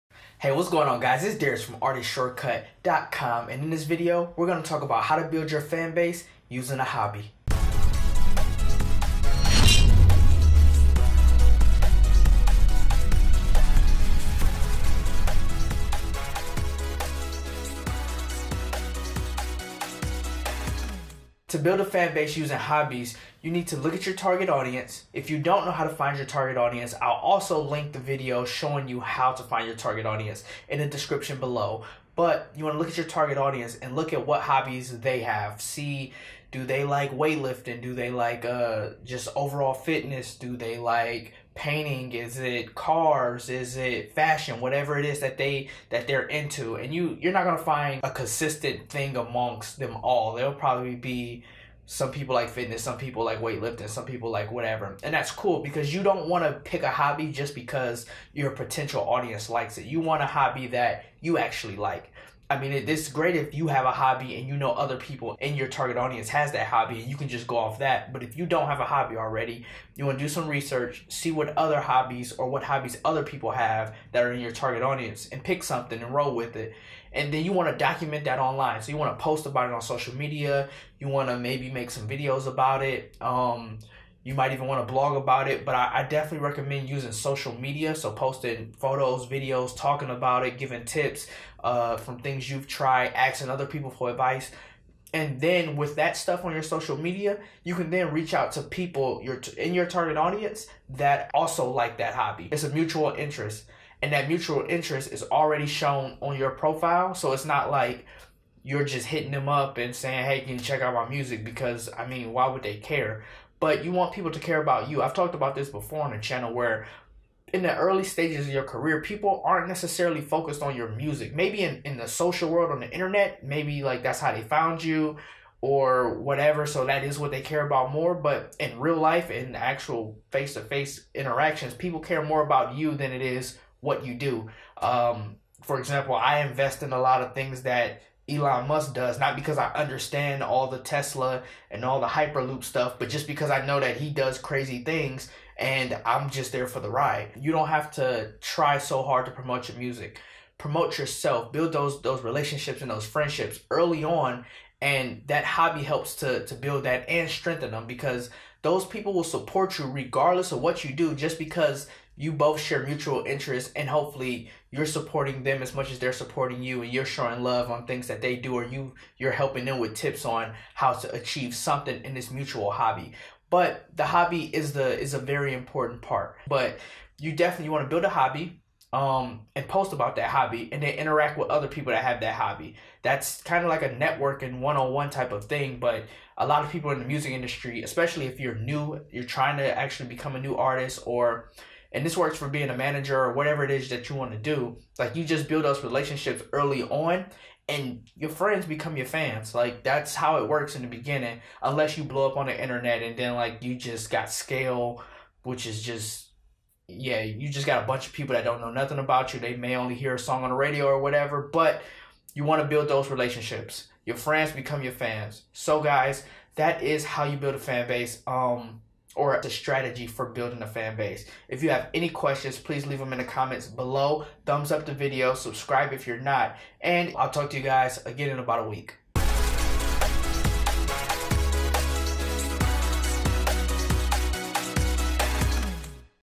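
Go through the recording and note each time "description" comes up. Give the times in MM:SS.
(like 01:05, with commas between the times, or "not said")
00:30.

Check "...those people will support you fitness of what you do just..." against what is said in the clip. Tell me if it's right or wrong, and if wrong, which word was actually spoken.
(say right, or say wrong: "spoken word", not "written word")
wrong: "regardless", not "fitness".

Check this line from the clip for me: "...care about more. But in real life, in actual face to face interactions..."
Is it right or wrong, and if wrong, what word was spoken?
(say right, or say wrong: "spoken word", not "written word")
right.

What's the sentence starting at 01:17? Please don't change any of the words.
And then you want to document that online.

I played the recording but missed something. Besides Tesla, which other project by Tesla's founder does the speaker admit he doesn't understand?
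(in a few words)
Hyperloop.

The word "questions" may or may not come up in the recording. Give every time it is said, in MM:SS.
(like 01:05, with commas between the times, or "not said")
03:42.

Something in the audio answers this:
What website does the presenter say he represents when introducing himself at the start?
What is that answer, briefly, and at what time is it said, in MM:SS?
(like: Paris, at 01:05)
ArtistShortcut.com, at 00:01.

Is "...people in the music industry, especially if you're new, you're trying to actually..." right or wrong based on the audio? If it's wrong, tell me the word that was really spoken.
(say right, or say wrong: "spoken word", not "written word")
right.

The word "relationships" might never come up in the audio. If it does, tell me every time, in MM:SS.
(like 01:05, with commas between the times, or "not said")
02:32, 03:15, 03:33.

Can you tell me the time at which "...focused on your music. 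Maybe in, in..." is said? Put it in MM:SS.
02:00.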